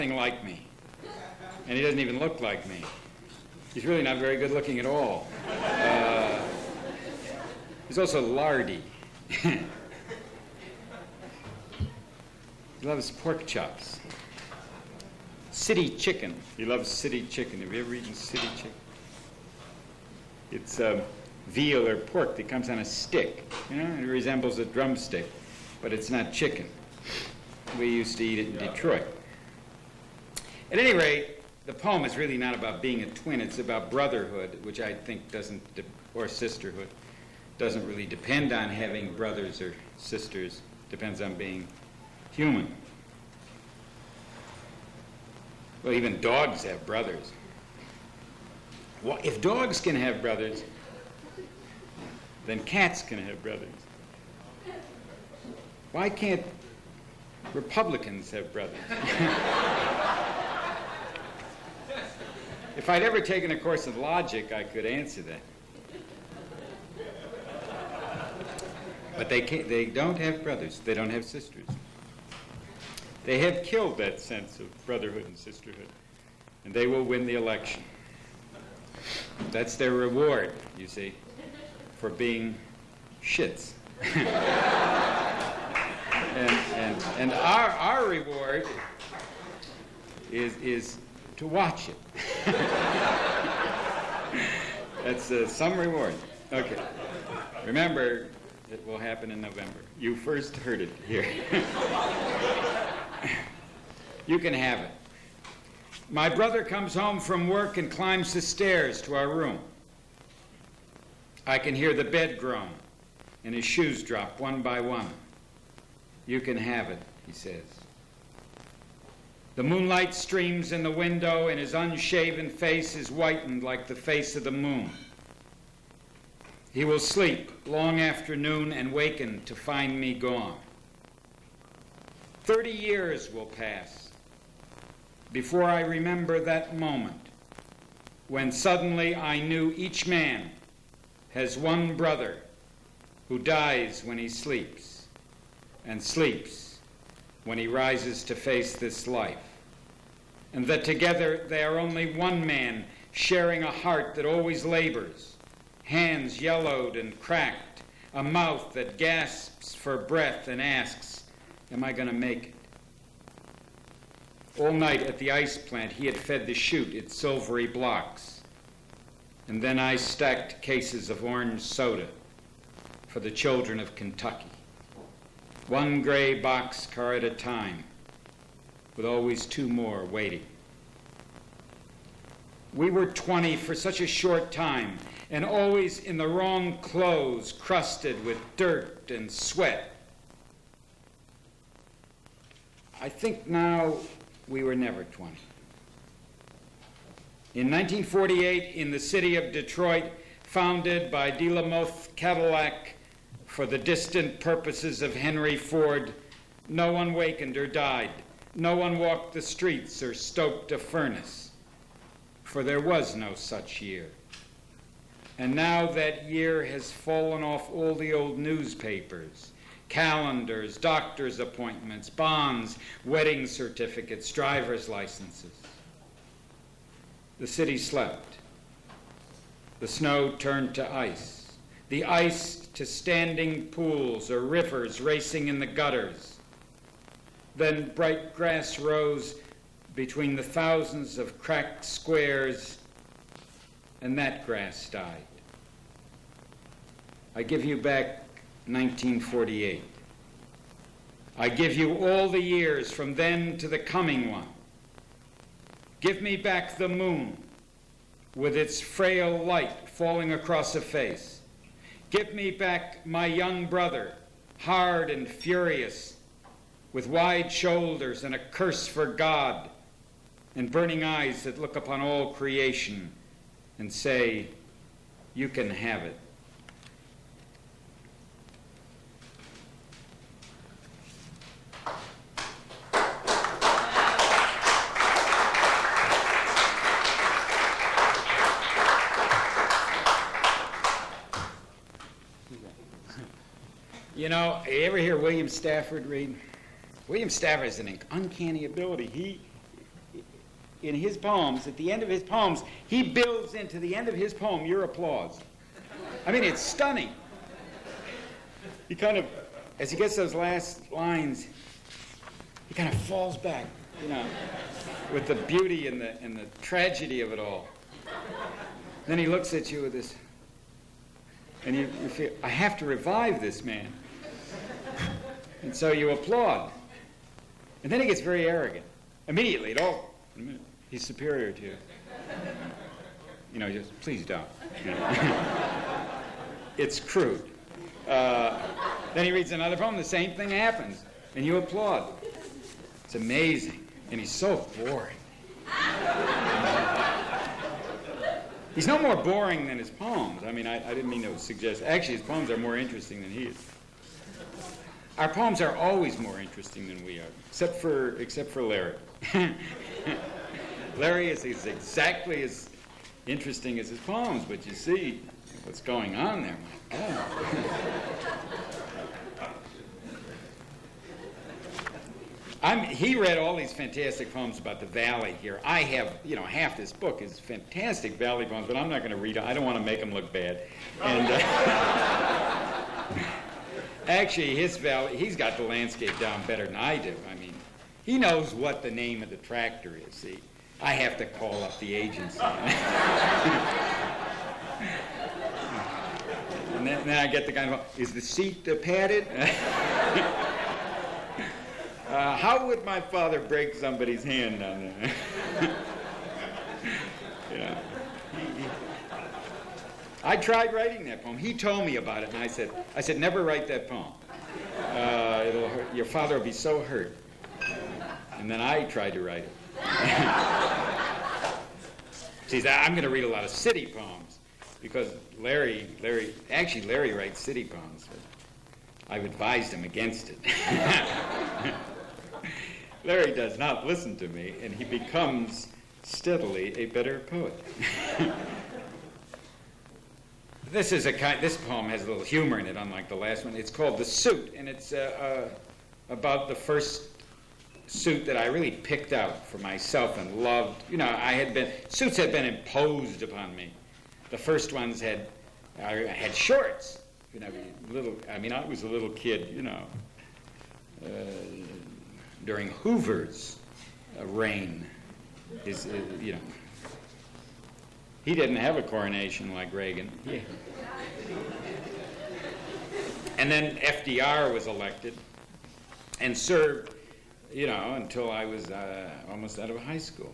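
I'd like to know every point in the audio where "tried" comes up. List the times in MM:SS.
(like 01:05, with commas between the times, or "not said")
06:50, 06:58.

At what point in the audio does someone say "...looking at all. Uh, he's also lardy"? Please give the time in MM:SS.
00:04.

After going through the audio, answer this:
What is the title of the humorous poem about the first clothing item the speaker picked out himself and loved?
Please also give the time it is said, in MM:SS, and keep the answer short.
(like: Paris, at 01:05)
The Suit, at 07:23.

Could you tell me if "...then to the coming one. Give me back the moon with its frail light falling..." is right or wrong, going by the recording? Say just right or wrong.
right.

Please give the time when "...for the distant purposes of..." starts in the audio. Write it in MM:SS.
03:23.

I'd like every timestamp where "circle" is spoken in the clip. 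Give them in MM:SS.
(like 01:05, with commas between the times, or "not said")
not said.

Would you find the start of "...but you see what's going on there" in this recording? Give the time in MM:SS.
06:04.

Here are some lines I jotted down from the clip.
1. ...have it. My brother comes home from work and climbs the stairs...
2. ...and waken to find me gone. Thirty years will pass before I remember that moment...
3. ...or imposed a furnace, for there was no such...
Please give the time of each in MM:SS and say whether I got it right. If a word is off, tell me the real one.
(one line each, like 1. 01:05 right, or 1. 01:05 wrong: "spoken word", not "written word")
1. 01:44 right
2. 02:08 right
3. 03:29 wrong: "stoked", not "imposed".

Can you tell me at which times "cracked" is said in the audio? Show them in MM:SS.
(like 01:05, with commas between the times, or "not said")
02:37, 04:01.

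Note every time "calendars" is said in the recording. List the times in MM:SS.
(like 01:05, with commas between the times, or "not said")
03:39.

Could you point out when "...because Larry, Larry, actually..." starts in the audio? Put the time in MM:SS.
07:04.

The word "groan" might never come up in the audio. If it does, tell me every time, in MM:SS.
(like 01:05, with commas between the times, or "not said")
01:52.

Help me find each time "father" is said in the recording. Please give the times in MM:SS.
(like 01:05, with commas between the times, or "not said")
06:42, 06:56.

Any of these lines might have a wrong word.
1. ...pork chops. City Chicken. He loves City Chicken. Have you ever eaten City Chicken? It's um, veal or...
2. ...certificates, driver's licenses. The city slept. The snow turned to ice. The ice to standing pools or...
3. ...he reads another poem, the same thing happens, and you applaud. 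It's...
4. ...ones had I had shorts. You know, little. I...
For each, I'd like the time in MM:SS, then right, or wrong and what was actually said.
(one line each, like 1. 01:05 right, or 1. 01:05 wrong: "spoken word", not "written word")
1. 00:13 right
2. 03:43 right
3. 05:39 right
4. 07:34 right.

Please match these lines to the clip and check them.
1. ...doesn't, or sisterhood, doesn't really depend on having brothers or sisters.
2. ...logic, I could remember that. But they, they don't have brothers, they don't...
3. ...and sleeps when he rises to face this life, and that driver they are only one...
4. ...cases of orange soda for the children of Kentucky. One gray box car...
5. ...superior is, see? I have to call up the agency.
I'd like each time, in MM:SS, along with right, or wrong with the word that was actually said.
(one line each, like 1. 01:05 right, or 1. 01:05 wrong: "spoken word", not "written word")
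1. 00:35 right
2. 01:03 wrong: "answer", not "remember"
3. 02:25 wrong: "together", not "driver"
4. 02:50 right
5. 06:29 wrong: "tractor", not "superior".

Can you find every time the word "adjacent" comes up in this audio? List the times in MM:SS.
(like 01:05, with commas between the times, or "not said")
not said.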